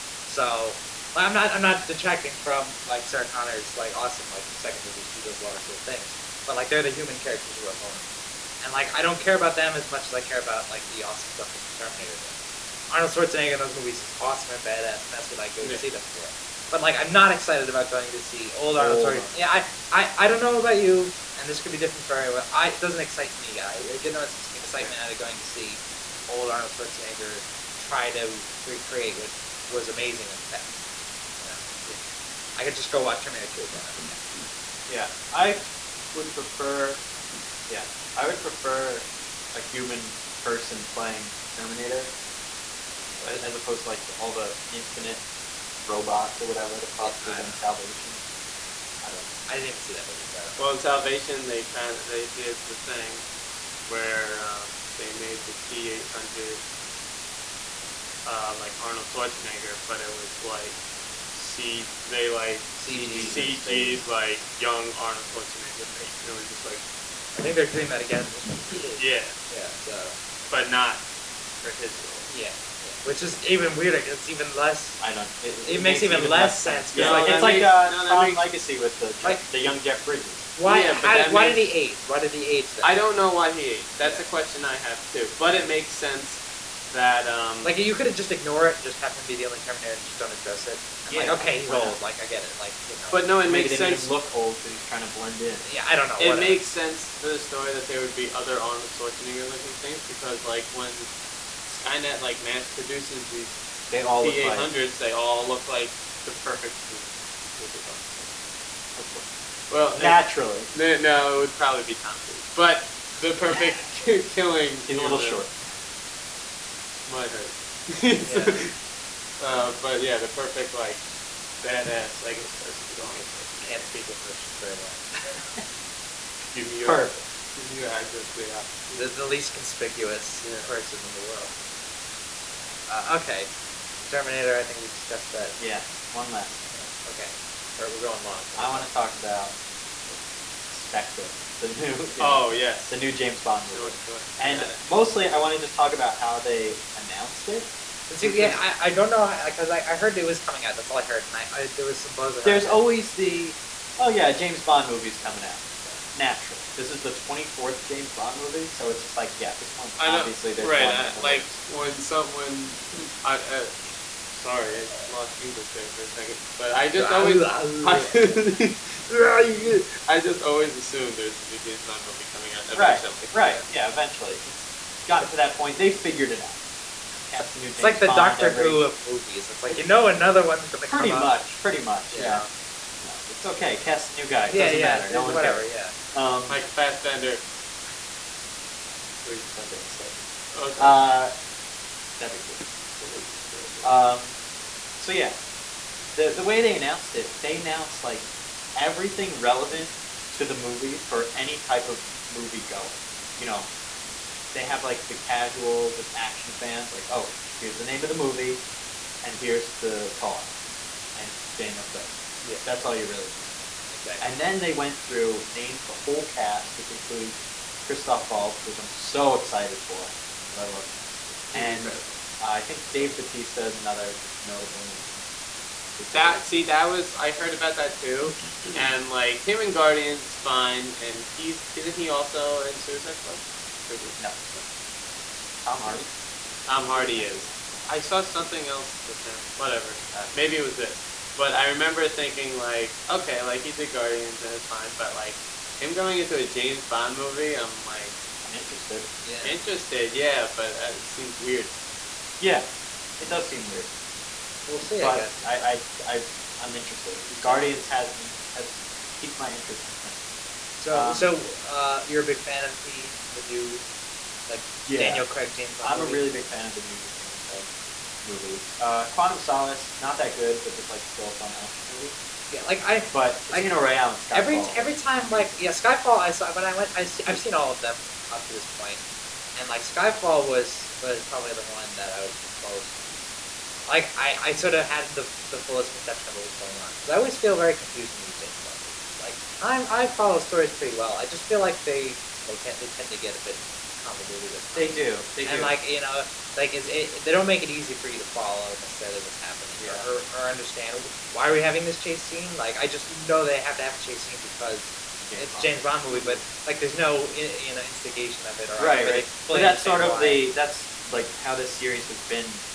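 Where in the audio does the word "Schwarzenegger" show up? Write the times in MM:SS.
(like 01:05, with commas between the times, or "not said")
00:13, 00:19, 00:26, 00:59, 01:05, 01:38, 01:48.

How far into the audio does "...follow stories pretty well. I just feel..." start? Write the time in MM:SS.
04:50.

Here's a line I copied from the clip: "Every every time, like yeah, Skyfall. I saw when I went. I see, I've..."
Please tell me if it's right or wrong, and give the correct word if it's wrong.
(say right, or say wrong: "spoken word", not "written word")
right.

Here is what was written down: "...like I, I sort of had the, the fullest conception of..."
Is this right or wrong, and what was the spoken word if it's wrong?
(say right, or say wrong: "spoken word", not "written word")
right.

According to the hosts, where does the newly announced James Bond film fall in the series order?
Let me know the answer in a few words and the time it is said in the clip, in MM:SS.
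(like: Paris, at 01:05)
24th, at 02:37.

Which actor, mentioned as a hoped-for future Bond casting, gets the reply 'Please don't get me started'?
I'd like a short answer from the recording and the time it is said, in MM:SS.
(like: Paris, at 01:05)
Mike Fassbender, at 03:06.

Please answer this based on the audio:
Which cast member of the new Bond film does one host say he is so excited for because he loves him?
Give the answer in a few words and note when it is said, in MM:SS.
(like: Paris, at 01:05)
Christoph Waltz, at 03:37.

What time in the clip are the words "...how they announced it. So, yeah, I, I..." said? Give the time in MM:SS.
02:26.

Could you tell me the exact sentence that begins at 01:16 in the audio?
No, like, it's makes, like a no, Tron makes, Legacy with the Jeff, like, the young Jeff Bridges.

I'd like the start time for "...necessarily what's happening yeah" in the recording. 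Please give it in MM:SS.
04:58.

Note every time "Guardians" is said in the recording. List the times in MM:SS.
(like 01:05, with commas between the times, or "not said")
03:49, 04:03, 04:17.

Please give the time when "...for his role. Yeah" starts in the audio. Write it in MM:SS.
01:11.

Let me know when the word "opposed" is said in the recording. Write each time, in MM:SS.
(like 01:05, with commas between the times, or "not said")
00:43.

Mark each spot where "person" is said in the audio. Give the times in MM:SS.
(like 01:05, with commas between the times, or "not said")
00:40, 02:02, 02:10.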